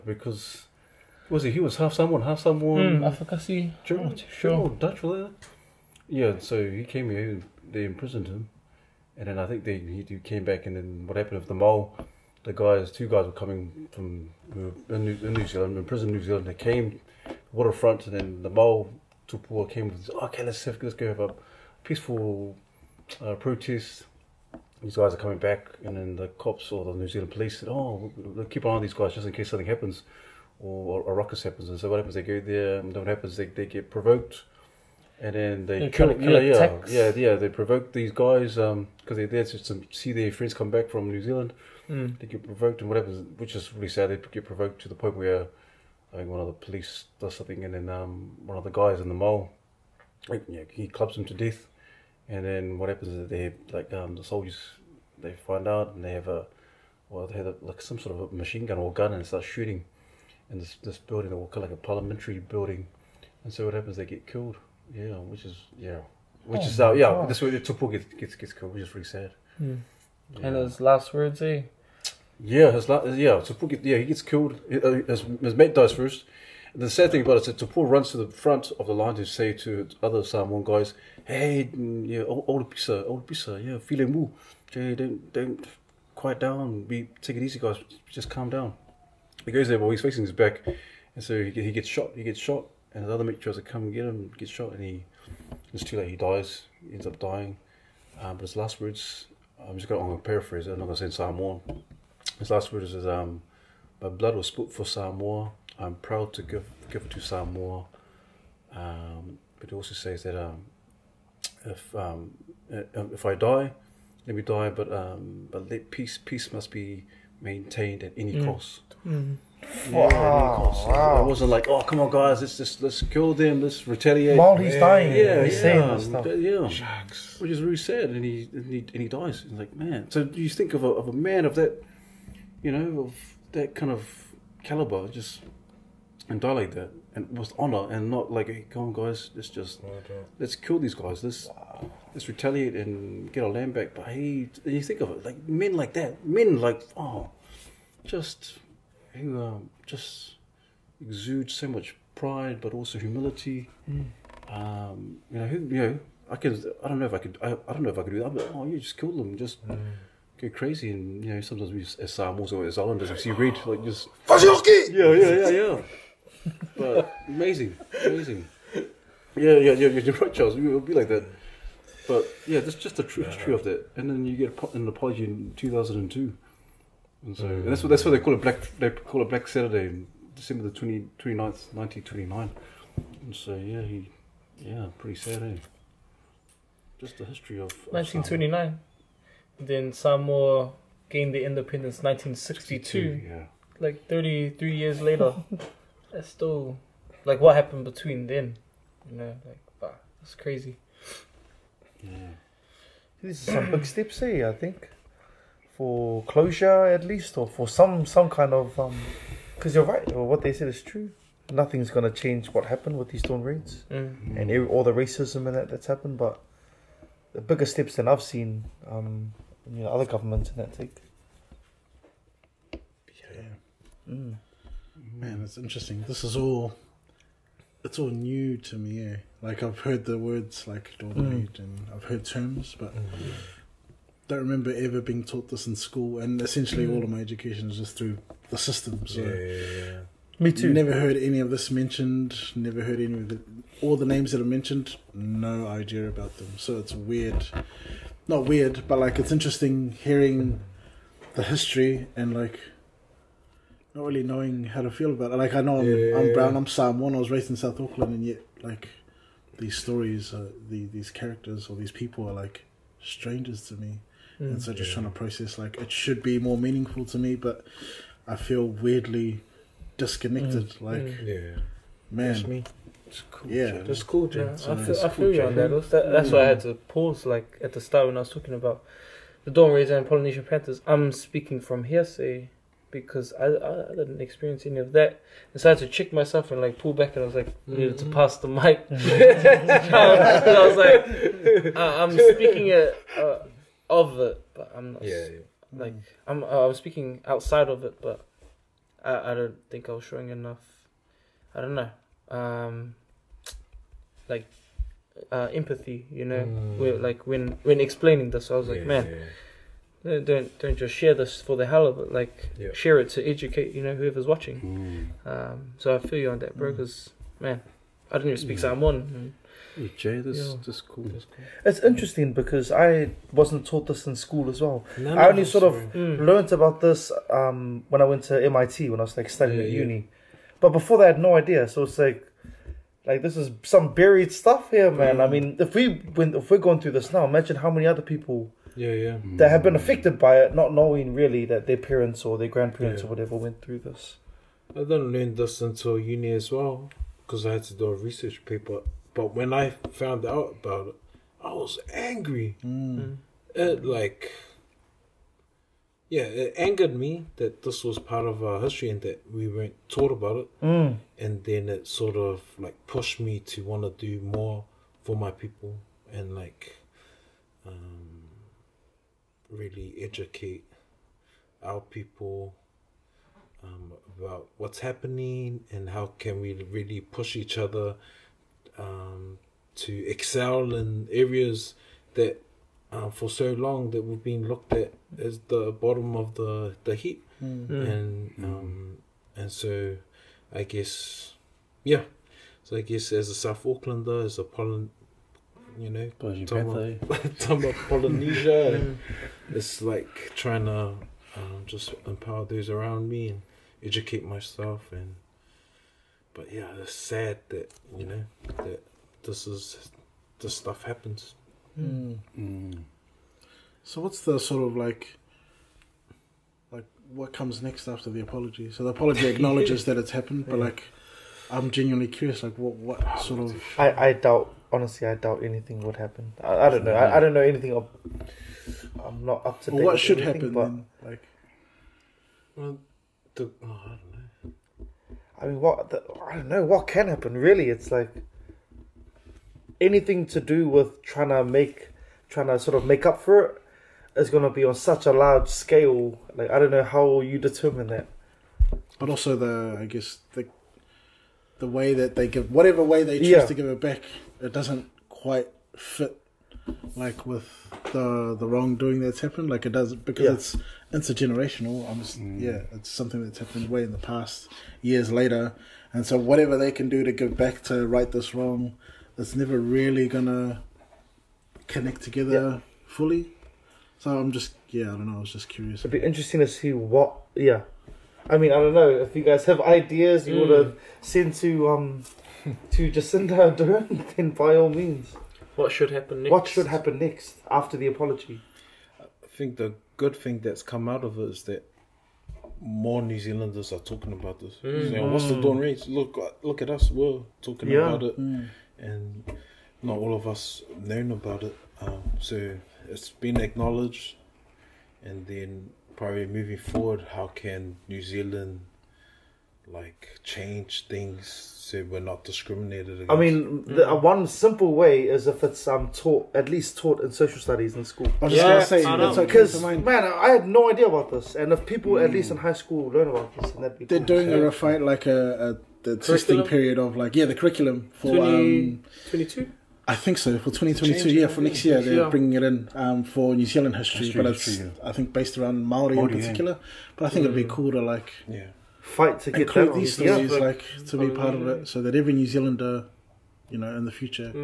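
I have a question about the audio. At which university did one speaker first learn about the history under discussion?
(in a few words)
MIT.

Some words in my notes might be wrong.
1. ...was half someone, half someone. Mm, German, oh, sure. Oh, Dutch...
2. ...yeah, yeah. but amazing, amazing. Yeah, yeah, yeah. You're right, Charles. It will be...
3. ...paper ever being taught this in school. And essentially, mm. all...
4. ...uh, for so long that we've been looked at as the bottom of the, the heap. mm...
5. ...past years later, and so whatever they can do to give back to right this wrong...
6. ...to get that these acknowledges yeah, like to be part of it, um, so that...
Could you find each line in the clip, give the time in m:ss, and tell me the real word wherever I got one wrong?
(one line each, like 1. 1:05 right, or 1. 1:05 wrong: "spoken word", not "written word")
1. 0:01 right
2. 2:45 right
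3. 3:54 wrong: "remember", not "paper"
4. 6:22 right
5. 7:43 right
6. 8:59 wrong: "stories", not "acknowledges".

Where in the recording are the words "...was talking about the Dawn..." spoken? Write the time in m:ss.
4:38.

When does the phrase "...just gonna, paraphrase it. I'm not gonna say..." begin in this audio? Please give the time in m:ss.
1:39.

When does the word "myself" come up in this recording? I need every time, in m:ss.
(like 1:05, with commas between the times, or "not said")
4:46, 6:44.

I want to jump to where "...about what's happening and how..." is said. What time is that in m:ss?
6:14.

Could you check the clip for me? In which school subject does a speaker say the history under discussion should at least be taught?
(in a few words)
Social studies.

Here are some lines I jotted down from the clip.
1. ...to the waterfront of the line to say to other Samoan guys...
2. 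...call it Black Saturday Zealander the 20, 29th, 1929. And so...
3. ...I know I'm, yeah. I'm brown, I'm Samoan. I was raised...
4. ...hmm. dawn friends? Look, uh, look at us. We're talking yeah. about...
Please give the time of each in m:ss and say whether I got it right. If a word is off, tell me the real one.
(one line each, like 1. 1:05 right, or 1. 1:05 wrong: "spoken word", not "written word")
1. 1:18 wrong: "front", not "waterfront"
2. 2:58 wrong: "December", not "Zealander"
3. 4:15 right
4. 8:15 wrong: "raids", not "friends".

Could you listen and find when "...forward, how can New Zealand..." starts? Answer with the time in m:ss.
8:26.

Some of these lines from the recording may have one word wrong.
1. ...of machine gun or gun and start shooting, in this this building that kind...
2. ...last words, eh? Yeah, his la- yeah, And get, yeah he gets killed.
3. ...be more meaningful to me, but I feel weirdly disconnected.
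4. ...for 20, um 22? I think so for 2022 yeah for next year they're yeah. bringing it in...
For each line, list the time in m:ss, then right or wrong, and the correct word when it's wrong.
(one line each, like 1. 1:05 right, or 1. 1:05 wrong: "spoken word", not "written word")
1. 0:58 right
2. 1:10 wrong: "Tupua", not "And"
3. 4:26 right
4. 8:47 right.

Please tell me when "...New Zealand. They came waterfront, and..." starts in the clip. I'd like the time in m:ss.
0:16.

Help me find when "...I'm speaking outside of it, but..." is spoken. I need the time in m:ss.
4:56.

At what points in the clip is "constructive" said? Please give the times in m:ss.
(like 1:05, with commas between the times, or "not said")
not said.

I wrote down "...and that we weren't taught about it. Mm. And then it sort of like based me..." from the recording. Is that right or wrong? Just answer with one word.
wrong.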